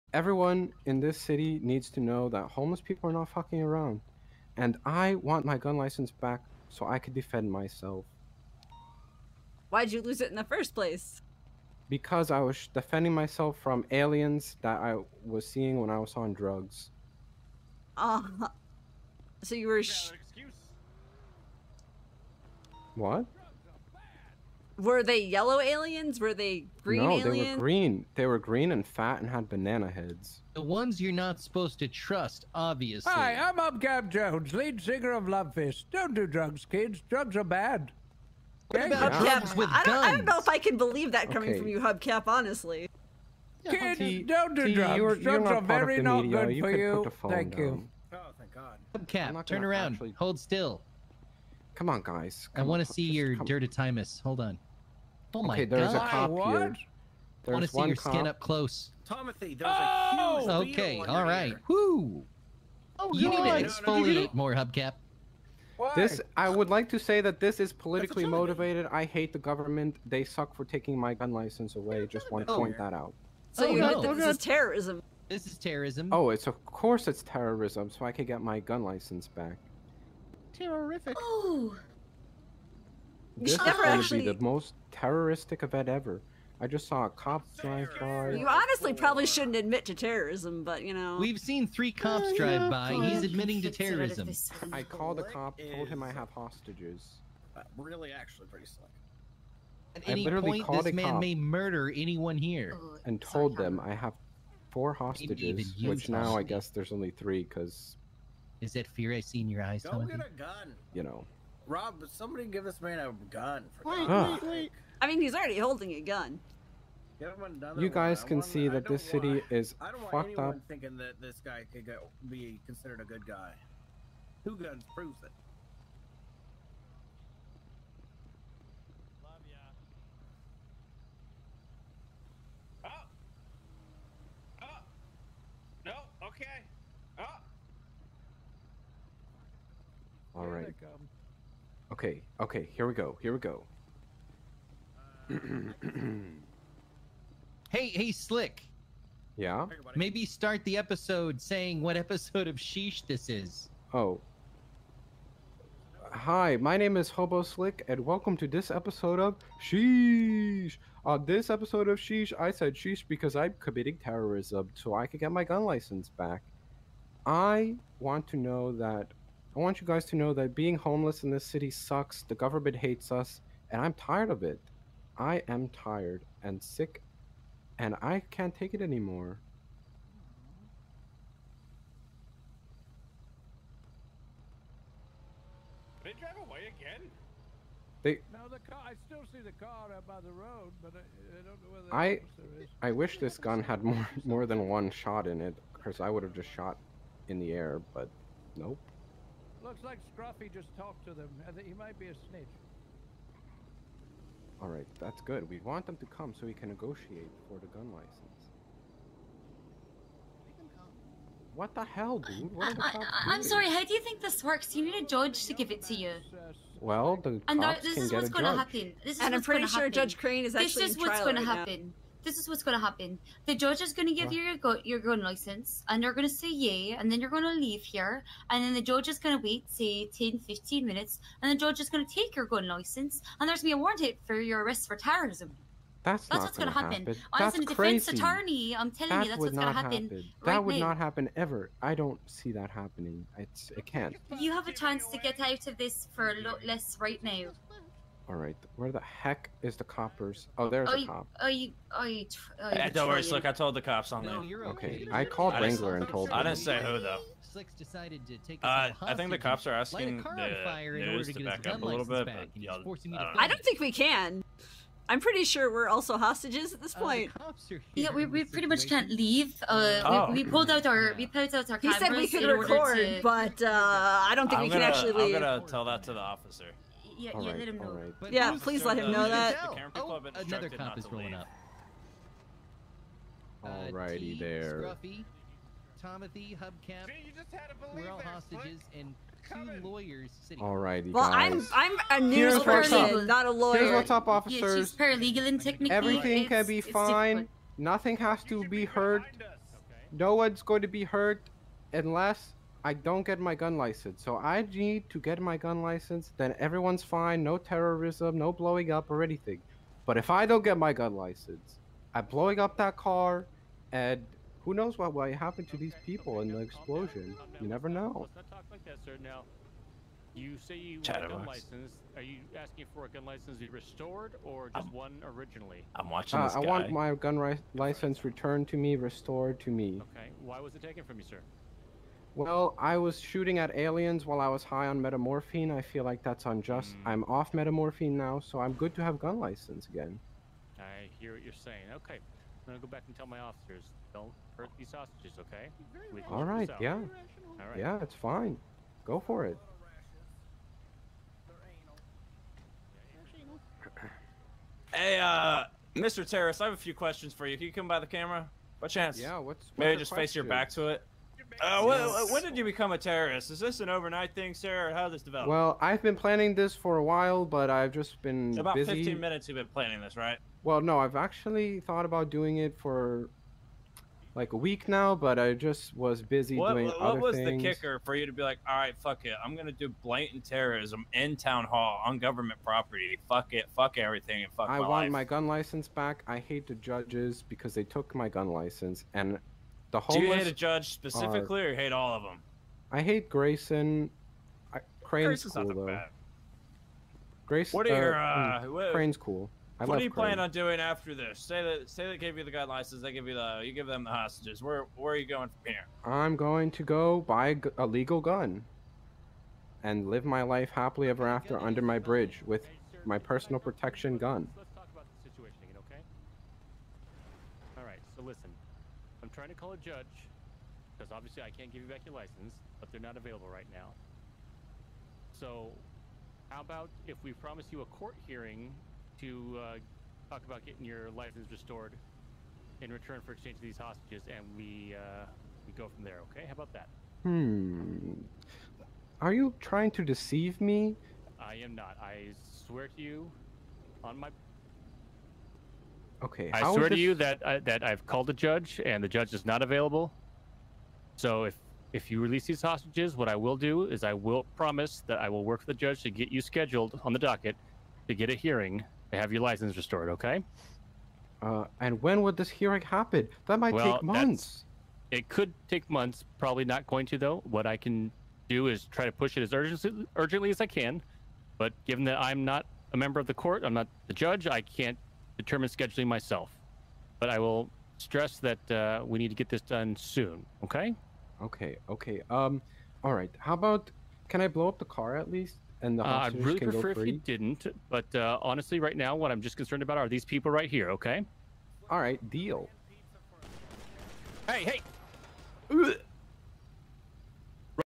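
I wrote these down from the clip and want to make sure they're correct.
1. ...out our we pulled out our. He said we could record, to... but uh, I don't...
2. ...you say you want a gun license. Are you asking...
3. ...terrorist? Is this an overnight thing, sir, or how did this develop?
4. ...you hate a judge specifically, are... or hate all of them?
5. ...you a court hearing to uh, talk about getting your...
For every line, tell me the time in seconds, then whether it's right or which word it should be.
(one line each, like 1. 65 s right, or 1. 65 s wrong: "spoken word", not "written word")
1. 270 s right
2. 320 s right
3. 362 s right
4. 390 s right
5. 427 s right.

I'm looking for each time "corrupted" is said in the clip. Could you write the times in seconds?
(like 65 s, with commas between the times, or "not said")
not said.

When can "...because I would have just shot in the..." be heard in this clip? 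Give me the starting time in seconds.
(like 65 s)
195 s.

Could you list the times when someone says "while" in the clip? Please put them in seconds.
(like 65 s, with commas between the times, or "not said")
334 s, 367 s.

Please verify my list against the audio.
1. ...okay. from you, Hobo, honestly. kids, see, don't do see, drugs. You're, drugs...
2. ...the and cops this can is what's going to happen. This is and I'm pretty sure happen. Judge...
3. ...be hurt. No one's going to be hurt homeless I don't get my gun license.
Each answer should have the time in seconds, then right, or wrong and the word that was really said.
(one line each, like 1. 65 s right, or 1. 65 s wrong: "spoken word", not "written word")
1. 41 s wrong: "Hubcap", not "Hobo"
2. 217 s right
3. 298 s wrong: "unless", not "homeless".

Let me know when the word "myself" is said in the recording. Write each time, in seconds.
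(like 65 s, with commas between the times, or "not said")
7 s, 13 s, 476 s.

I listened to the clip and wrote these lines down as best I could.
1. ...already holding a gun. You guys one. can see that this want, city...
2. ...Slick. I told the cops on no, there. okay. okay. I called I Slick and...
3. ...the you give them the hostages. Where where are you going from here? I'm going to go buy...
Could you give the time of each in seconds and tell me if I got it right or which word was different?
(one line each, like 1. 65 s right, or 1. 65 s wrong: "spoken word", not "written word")
1. 115 s right
2. 253 s wrong: "Wrangler", not "Slick"
3. 403 s right.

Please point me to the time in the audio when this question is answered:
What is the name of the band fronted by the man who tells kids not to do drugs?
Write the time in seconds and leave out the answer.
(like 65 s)
35 s.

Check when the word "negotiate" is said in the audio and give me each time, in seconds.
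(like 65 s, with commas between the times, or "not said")
206 s.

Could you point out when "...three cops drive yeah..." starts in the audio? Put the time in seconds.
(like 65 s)
91 s.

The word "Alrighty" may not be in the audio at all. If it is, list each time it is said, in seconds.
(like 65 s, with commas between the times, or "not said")
283 s, 290 s.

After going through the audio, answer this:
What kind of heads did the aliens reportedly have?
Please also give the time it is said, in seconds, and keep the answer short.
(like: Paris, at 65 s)
Banana heads, at 29 s.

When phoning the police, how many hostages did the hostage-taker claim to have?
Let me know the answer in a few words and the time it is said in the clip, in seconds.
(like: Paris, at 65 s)
4, at 104 s.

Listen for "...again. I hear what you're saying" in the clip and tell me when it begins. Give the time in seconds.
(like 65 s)
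339 s.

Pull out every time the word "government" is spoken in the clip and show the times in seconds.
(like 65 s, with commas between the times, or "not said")
69 s, 172 s, 382 s.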